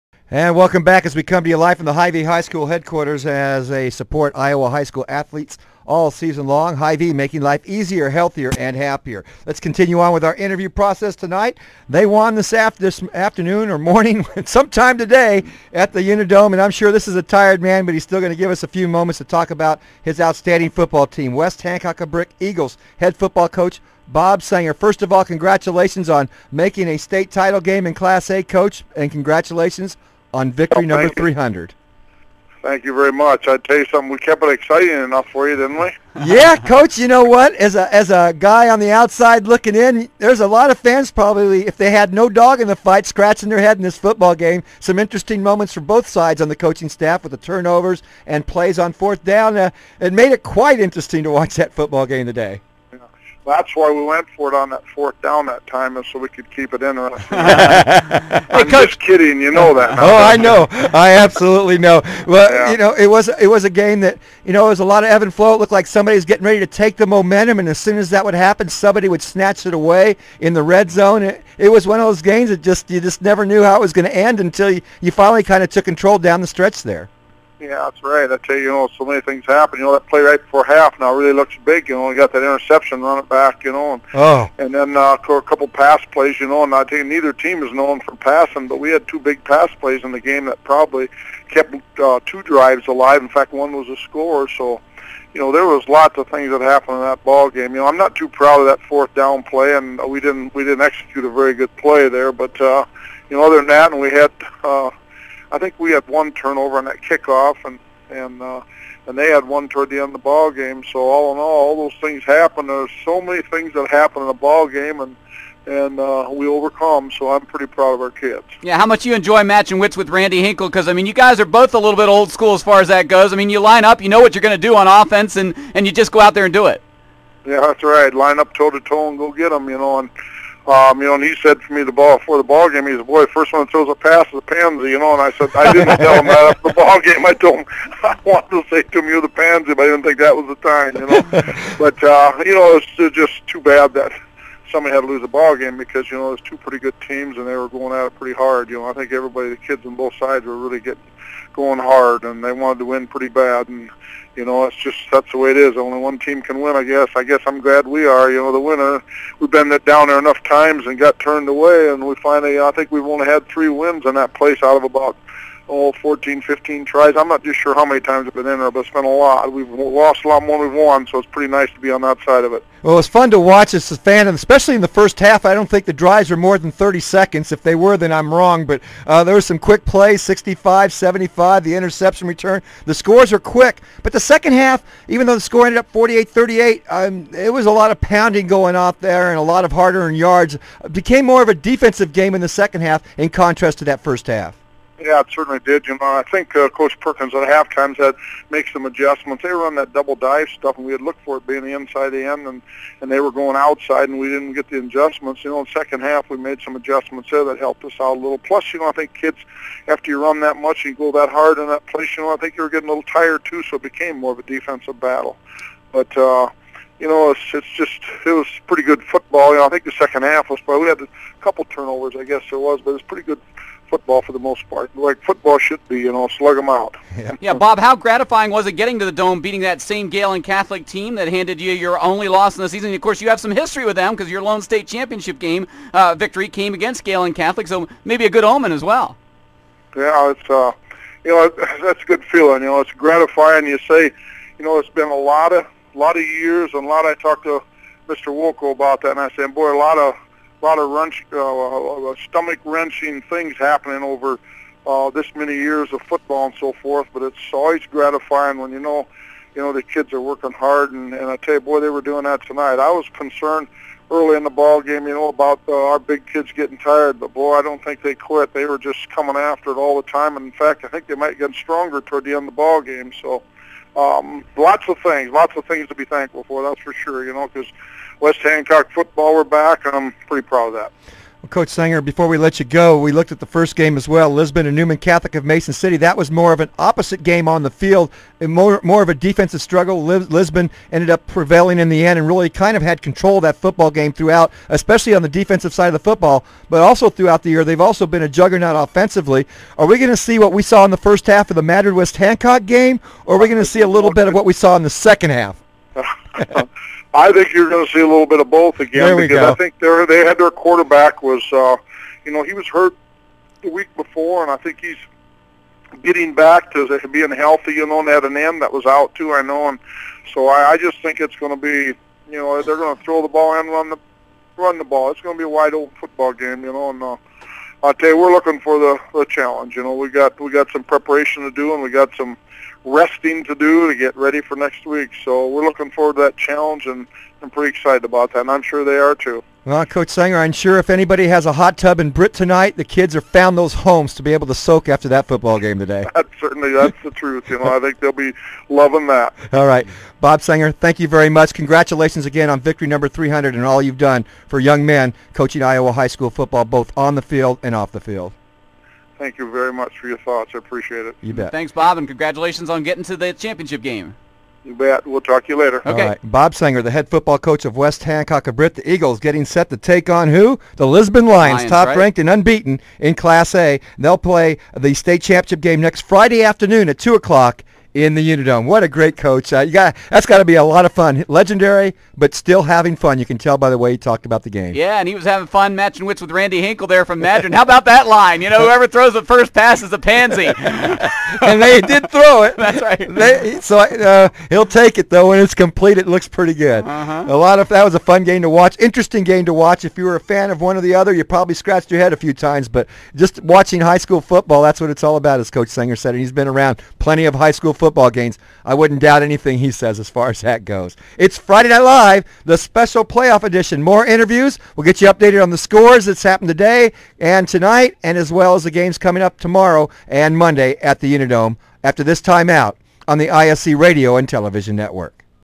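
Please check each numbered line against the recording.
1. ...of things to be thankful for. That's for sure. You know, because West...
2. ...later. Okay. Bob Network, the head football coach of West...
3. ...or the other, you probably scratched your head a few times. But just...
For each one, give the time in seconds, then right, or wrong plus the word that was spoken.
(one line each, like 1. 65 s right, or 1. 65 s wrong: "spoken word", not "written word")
1. 275 s right
2. 365 s wrong: "Sanger", not "Network"
3. 400 s right.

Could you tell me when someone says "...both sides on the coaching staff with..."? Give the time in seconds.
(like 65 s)
45 s.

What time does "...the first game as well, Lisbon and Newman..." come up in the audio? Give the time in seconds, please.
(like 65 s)
283 s.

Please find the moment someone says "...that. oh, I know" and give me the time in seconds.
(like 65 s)
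59 s.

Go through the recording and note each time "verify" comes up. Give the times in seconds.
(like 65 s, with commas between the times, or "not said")
not said.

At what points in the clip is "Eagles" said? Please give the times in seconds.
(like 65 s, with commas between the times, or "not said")
22 s, 368 s.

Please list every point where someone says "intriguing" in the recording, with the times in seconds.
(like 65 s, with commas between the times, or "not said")
not said.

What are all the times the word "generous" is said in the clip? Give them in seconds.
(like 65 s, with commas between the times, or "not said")
not said.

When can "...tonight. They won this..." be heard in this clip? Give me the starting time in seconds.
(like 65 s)
11 s.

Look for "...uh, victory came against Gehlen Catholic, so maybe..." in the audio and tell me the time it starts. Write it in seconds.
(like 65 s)
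235 s.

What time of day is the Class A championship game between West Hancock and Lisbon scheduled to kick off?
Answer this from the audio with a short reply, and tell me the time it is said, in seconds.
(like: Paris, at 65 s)
2 o'clock, at 376 s.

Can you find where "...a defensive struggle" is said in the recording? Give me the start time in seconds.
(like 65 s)
289 s.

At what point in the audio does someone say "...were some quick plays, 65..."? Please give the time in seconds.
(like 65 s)
179 s.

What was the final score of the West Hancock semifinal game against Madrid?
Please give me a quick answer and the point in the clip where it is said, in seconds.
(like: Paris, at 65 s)
48-38, at 185 s.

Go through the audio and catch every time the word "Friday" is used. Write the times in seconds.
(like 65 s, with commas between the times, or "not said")
376 s, 411 s.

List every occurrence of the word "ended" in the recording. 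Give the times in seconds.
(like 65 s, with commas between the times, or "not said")
185 s, 290 s.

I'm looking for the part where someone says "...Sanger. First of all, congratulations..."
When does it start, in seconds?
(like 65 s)
24 s.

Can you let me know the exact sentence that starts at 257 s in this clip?
But it's always gratifying when you know, you know, the kids are working hard.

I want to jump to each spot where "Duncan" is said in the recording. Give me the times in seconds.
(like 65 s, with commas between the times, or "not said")
not said.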